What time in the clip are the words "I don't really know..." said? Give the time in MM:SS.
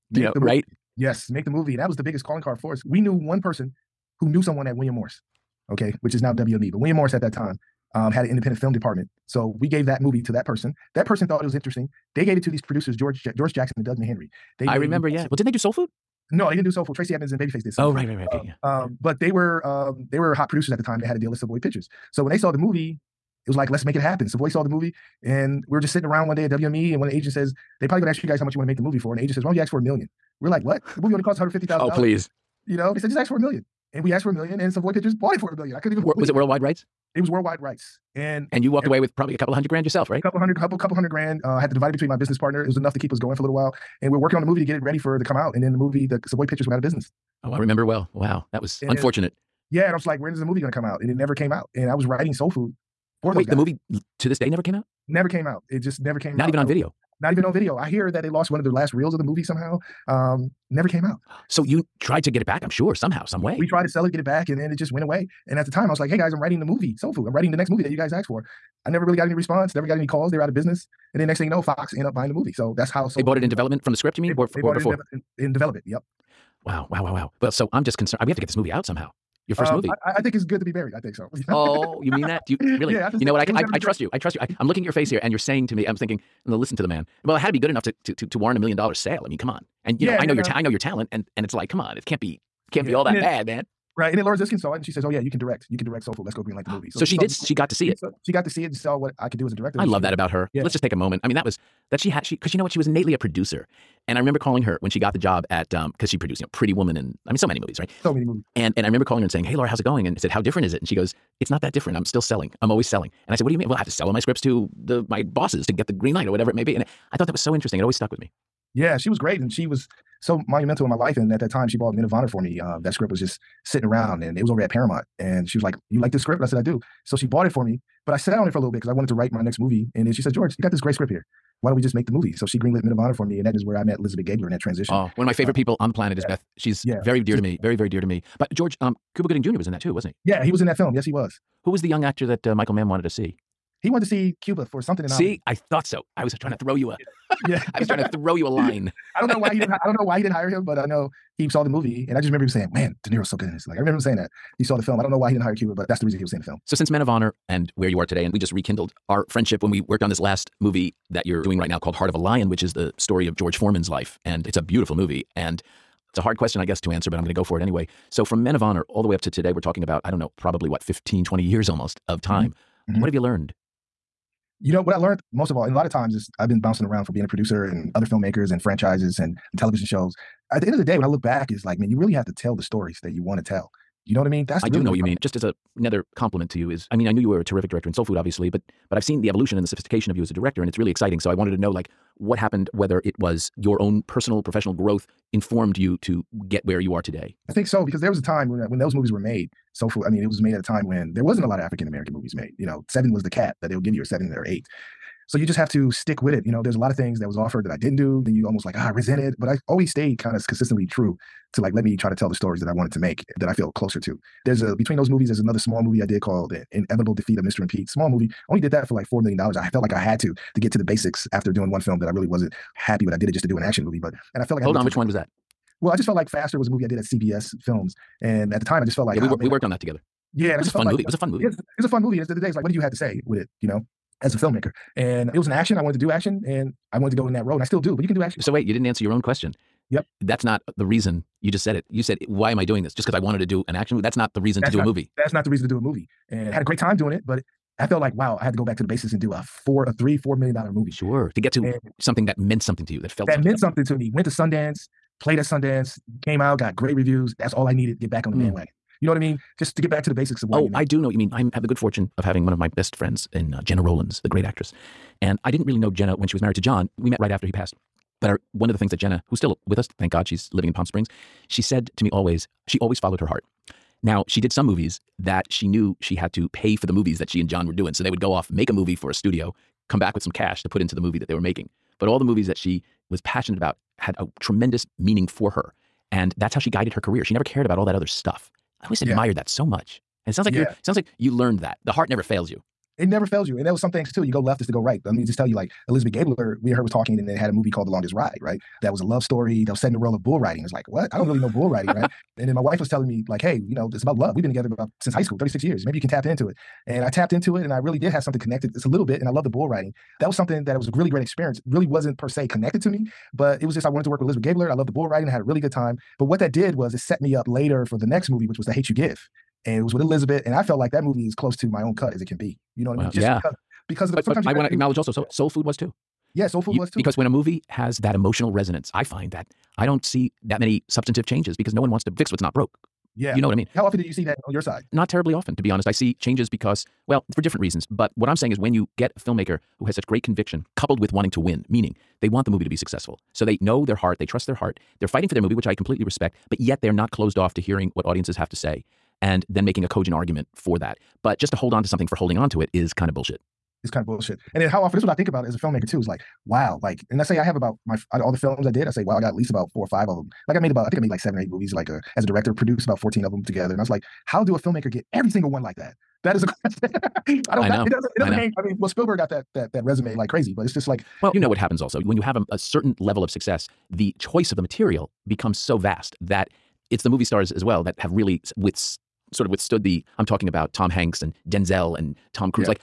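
05:01.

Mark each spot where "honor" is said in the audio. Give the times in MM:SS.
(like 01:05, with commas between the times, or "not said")
02:02, 02:12, 02:37, 02:48.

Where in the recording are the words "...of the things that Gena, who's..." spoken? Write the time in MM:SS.
04:28.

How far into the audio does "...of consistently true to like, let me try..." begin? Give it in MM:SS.
03:30.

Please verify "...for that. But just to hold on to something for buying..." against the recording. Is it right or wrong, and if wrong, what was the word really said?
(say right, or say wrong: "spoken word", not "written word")
wrong: "holding", not "buying".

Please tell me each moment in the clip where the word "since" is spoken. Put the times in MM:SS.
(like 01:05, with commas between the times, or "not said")
02:36, 05:05.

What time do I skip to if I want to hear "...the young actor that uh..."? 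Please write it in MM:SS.
02:21.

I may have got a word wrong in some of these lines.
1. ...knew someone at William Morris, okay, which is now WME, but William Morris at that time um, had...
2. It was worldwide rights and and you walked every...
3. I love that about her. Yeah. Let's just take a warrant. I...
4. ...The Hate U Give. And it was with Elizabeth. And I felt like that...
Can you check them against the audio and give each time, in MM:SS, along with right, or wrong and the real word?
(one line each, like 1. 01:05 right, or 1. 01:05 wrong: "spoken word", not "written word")
1. 00:04 right
2. 00:37 right
3. 01:39 wrong: "moment", not "warrant"
4. 05:18 right.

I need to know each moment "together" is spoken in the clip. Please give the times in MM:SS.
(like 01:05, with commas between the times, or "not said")
03:49, 05:04, 06:03.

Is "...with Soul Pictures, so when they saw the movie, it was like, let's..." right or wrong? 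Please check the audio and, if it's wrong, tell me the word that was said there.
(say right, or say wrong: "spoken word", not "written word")
wrong: "Savoy", not "Soul".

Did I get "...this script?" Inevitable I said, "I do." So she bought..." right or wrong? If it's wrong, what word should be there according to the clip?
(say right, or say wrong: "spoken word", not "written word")
wrong: "And", not "Inevitable".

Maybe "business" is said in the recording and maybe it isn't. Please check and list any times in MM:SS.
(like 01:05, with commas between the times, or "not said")
00:42, 00:46, 01:10.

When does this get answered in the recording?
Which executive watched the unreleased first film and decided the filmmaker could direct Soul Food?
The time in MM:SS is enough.
01:34.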